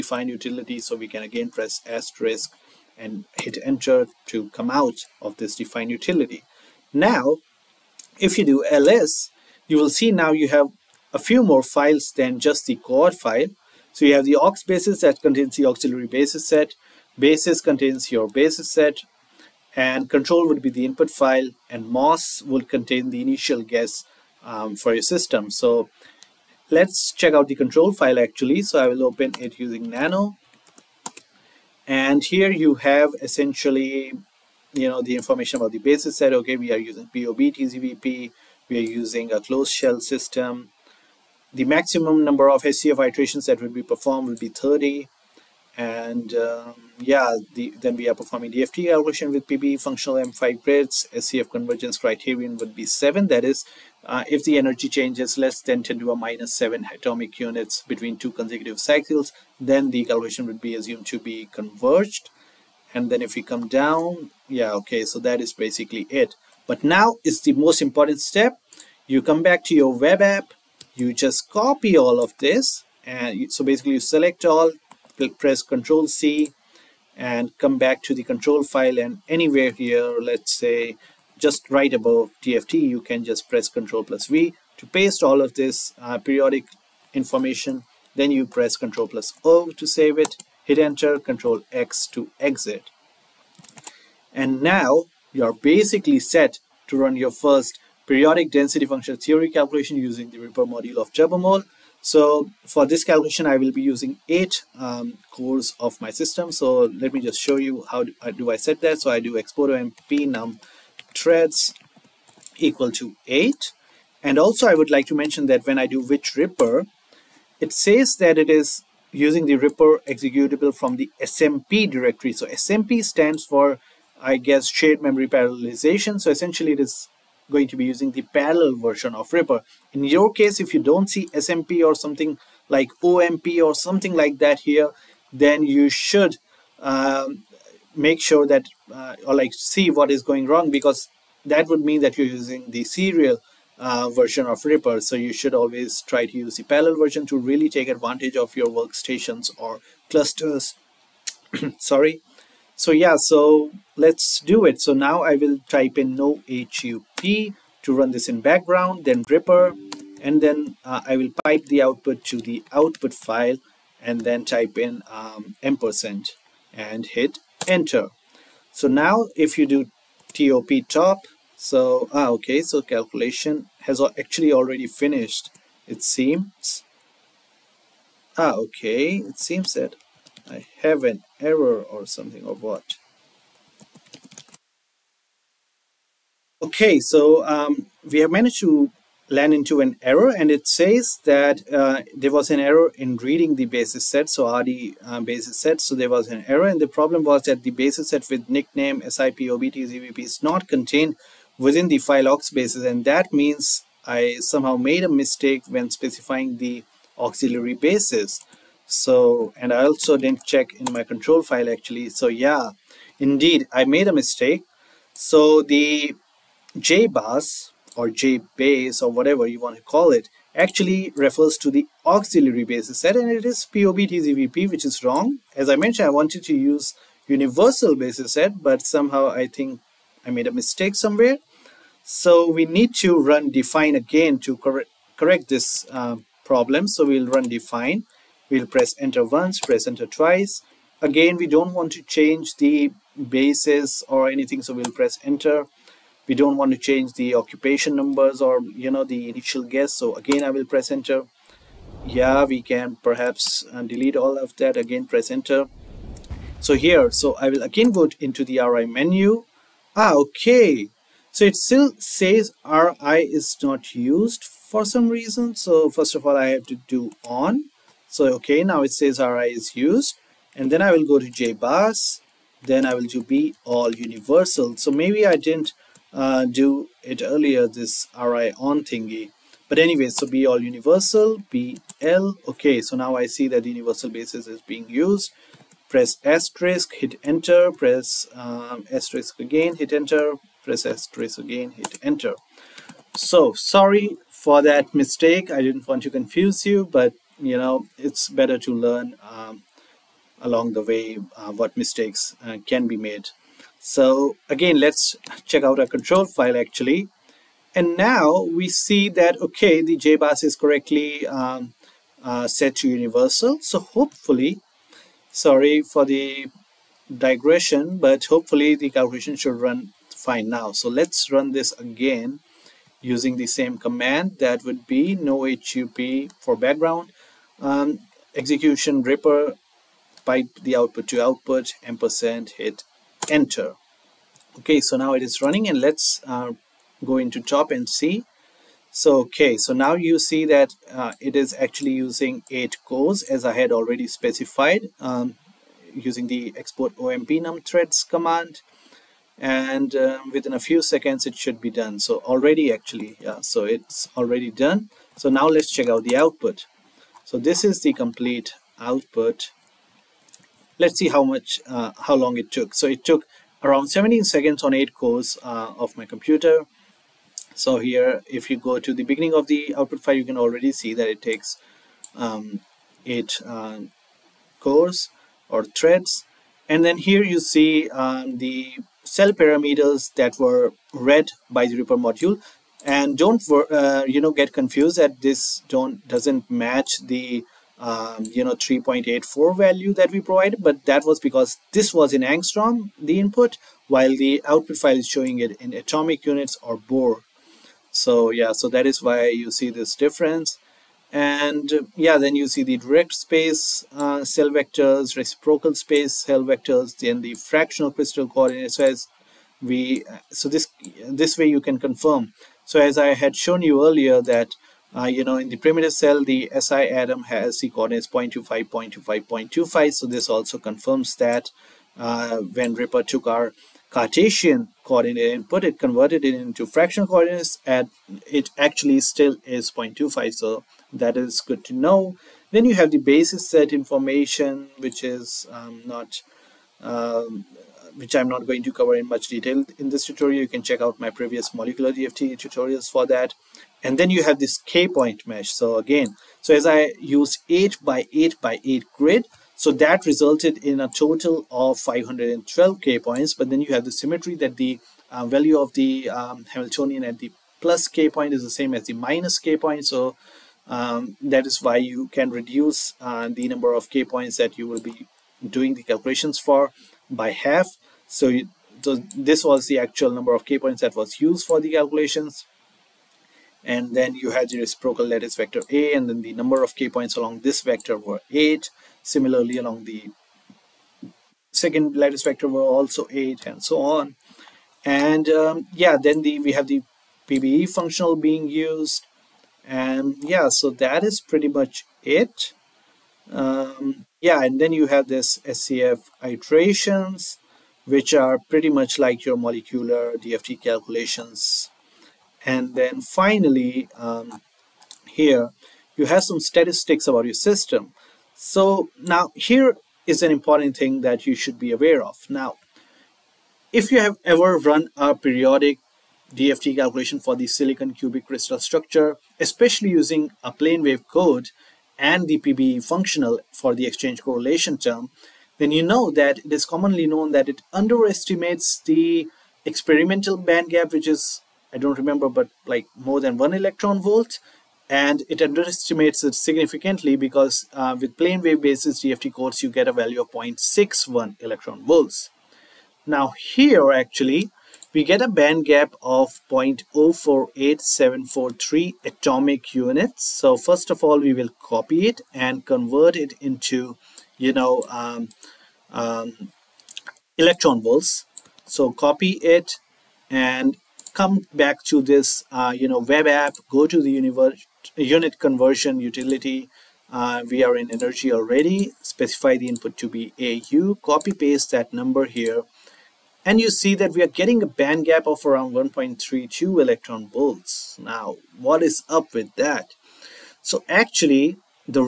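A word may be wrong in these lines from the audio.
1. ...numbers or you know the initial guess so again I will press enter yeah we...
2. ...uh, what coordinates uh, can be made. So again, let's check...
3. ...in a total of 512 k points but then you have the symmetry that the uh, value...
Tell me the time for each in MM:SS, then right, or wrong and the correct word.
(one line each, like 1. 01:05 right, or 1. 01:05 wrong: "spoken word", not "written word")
1. 04:07 right
2. 05:01 wrong: "mistakes", not "coordinates"
3. 07:30 right.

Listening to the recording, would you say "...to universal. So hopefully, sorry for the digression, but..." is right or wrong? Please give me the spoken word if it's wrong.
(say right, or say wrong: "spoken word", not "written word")
right.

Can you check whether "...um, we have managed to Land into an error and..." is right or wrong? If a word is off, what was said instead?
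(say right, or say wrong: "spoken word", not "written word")
right.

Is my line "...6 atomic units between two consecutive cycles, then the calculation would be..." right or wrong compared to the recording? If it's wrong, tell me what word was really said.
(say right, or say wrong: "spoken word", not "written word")
wrong: "7", not "6".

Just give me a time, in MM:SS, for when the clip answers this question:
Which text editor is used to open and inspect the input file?
00:29.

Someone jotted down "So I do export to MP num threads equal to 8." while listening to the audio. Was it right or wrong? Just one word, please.
right.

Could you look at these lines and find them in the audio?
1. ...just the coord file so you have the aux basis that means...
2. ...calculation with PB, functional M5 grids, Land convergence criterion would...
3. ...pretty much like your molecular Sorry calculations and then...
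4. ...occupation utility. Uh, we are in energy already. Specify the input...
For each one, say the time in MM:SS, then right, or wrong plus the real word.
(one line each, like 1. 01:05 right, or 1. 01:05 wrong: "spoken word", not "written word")
1. 00:12 wrong: "contains", not "means"
2. 00:48 wrong: "SCF", not "Land"
3. 08:18 wrong: "DFT", not "Sorry"
4. 09:25 wrong: "conversion", not "occupation".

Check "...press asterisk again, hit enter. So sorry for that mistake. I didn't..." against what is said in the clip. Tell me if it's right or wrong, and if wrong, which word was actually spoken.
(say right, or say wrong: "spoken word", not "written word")
right.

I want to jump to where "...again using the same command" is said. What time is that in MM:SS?
05:21.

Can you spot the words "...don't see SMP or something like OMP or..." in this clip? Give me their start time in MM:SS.
02:10.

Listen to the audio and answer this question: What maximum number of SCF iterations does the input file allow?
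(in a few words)
30.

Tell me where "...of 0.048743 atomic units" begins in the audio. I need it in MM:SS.
09:06.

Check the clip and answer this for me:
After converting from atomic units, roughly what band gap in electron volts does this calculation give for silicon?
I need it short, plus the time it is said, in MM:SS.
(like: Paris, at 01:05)
1.32 eV, at 09:35.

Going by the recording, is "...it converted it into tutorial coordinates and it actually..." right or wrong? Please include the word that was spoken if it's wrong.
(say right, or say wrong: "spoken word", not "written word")
wrong: "fractional", not "tutorial".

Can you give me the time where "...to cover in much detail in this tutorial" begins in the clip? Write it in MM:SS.
07:18.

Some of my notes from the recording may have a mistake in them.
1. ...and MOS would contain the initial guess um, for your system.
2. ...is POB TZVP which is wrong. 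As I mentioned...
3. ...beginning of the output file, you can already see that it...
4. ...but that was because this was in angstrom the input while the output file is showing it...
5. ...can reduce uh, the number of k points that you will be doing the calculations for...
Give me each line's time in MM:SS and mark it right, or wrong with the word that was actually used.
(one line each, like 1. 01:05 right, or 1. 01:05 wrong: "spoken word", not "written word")
1. 00:21 right
2. 03:43 right
3. 06:09 right
4. 06:30 right
5. 07:42 right.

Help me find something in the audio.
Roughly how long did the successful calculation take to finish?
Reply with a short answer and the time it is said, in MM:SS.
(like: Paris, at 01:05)
17 seconds, at 06:03.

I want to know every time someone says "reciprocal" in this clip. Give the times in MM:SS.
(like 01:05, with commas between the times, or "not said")
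06:45, 07:54.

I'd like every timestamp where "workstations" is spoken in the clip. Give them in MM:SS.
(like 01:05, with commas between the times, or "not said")
02:28.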